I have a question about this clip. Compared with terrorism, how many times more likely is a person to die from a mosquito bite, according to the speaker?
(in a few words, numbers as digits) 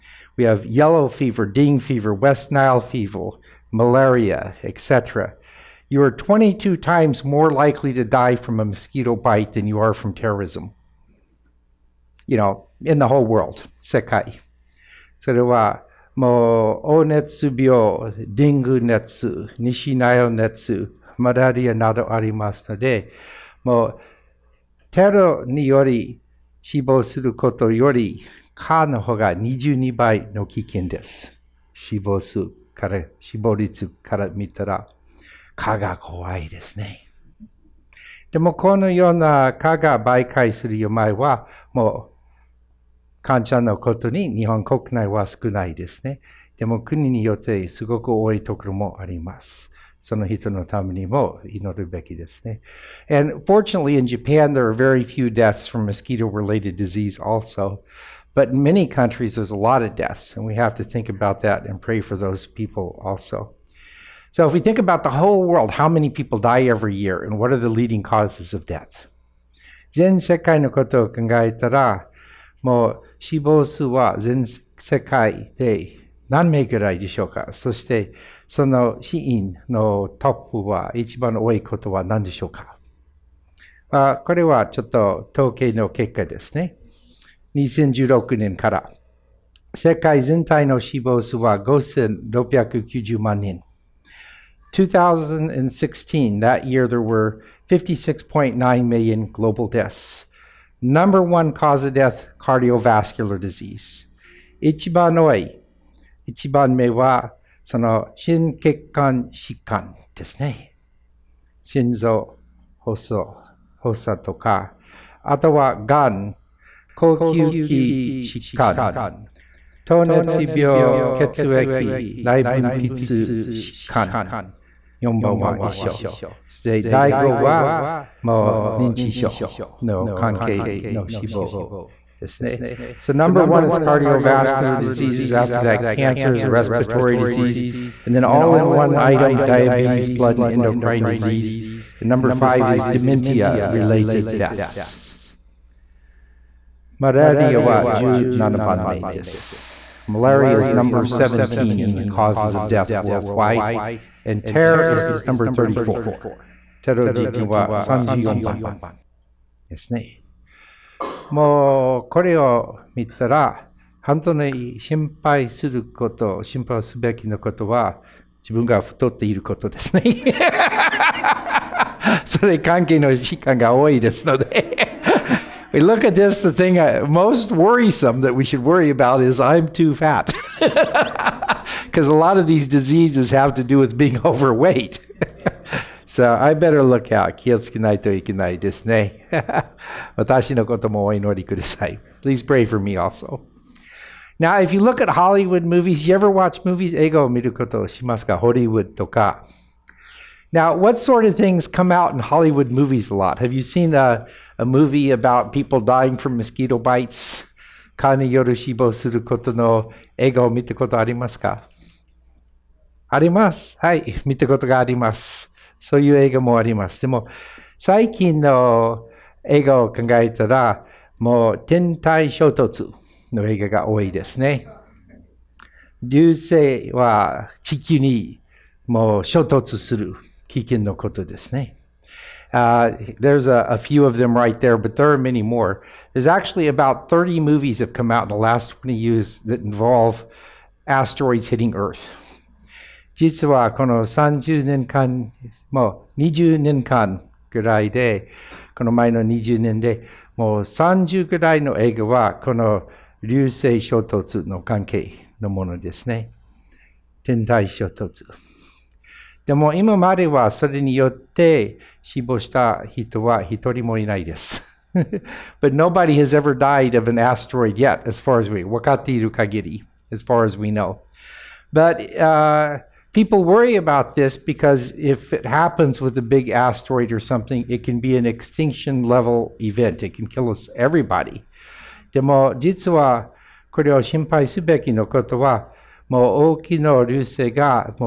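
22.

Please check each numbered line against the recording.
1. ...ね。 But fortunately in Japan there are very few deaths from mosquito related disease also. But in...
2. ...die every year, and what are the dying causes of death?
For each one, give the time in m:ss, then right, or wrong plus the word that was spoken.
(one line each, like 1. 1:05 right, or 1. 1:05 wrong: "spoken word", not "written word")
1. 0:52 wrong: "And", not "But"
2. 1:06 wrong: "leading", not "dying".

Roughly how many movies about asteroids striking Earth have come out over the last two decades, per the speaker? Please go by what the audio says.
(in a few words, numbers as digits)
30.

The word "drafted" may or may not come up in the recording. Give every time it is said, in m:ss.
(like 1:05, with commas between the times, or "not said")
not said.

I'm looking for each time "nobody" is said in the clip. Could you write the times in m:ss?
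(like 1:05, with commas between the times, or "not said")
4:25.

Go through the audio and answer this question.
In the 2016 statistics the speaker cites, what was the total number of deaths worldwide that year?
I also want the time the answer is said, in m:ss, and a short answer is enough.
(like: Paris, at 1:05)
56.9 million, at 1:37.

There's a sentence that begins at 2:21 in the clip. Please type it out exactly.
And number five is dementia related deaths.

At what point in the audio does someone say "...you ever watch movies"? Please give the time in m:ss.
3:16.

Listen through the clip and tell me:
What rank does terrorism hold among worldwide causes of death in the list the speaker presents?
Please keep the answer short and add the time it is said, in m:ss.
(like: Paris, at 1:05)
34, at 2:34.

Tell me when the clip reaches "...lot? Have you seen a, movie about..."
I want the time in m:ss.
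3:23.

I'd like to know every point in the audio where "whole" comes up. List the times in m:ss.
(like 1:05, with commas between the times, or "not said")
0:13, 1:05.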